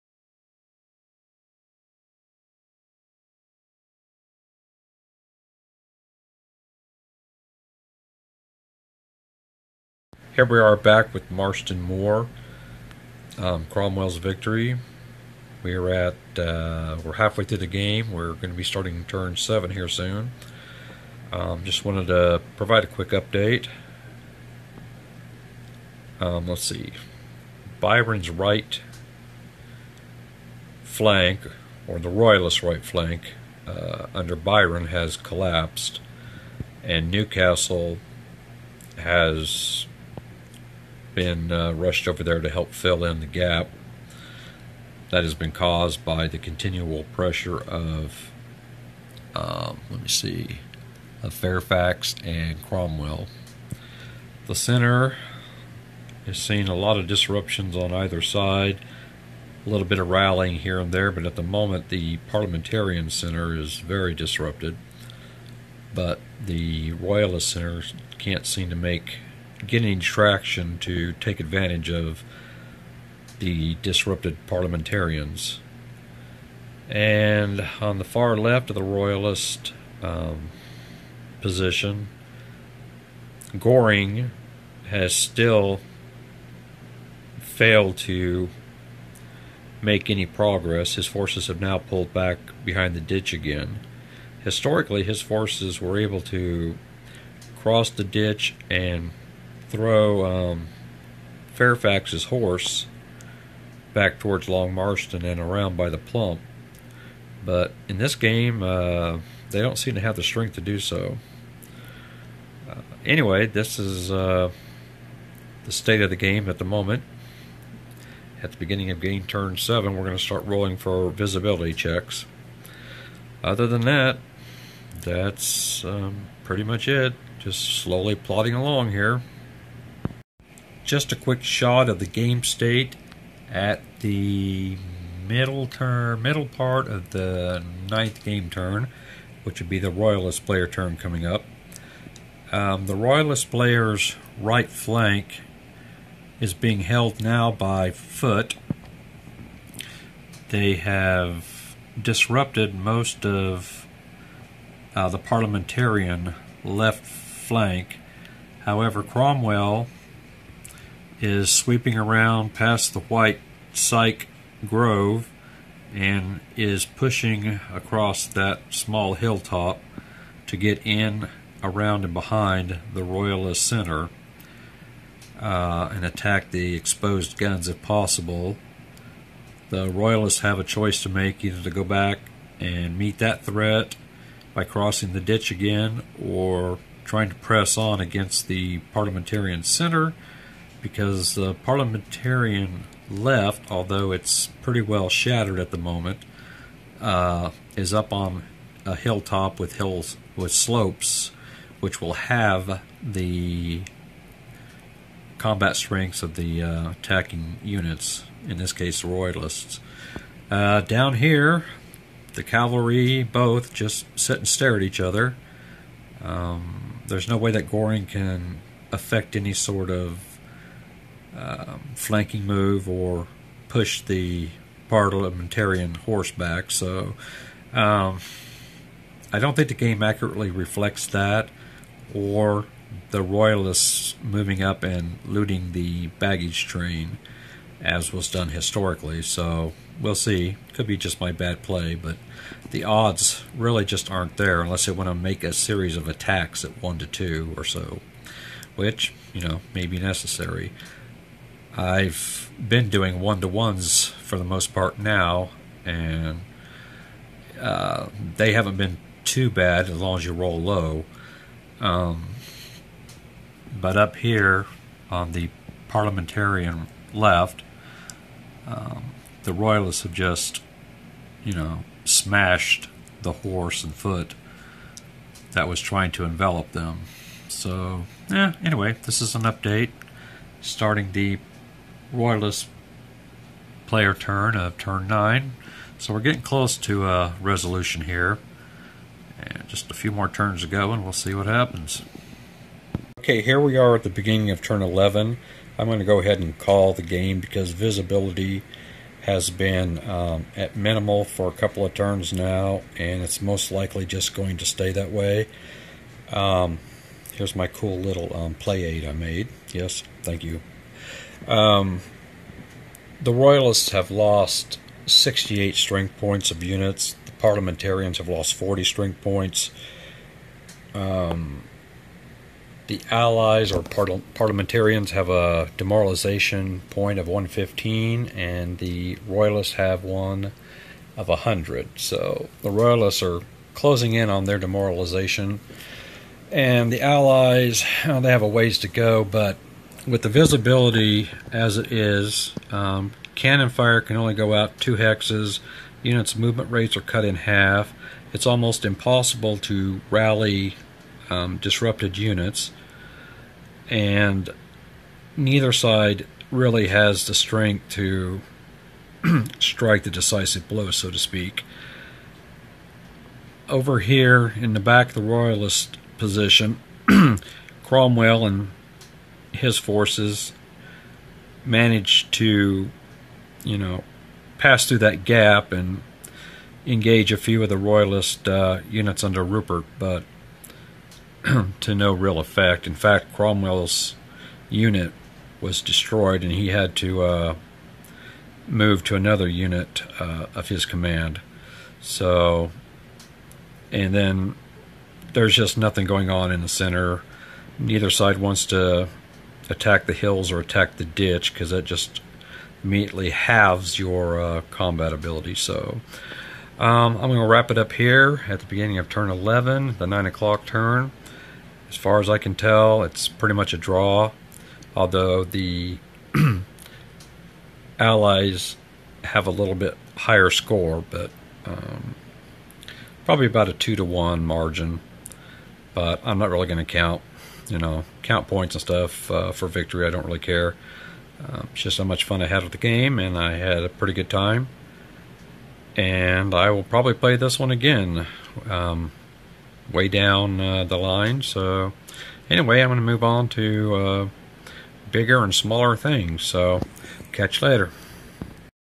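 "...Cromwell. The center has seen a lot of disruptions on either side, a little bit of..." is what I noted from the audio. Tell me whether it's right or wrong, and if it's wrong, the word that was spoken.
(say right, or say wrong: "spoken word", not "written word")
right.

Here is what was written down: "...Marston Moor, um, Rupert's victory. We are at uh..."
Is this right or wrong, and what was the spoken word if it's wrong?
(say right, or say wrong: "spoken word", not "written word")
wrong: "Cromwell", not "Rupert".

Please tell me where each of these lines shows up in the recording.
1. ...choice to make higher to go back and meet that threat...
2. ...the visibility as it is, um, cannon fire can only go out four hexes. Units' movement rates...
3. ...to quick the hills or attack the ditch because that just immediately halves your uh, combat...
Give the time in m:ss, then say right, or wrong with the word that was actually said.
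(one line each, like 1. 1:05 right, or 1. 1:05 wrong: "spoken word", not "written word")
1. 3:00 wrong: "either", not "higher"
2. 5:40 wrong: "two", not "four"
3. 6:38 wrong: "attack", not "quick".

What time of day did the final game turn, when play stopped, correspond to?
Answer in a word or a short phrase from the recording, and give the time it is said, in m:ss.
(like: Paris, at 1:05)
9 o'clock, at 6:50.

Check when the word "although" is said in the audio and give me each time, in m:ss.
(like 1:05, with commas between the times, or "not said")
3:13, 6:54.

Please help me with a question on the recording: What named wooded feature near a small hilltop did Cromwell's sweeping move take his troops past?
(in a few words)
White Syke Grove.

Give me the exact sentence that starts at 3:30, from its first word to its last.
Uh, down here, the cavalry both just sit and stare at each other.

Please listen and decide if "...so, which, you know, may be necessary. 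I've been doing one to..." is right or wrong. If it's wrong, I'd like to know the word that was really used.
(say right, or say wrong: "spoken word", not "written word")
right.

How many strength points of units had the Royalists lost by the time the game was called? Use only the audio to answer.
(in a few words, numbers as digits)
68.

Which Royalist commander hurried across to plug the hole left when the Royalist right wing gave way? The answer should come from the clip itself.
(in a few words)
Newcastle.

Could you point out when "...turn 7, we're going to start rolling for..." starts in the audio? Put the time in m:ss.
1:59.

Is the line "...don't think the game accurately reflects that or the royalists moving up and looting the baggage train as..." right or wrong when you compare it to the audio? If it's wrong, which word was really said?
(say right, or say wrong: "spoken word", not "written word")
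right.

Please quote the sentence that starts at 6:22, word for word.
In fact, Cromwell's unit was destroyed, and he had to uh, move to another unit uh, of his command.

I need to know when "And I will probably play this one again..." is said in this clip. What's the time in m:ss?
7:15.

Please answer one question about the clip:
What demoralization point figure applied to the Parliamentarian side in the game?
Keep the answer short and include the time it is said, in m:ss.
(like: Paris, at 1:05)
115, at 5:27.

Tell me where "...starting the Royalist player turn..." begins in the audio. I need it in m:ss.
4:40.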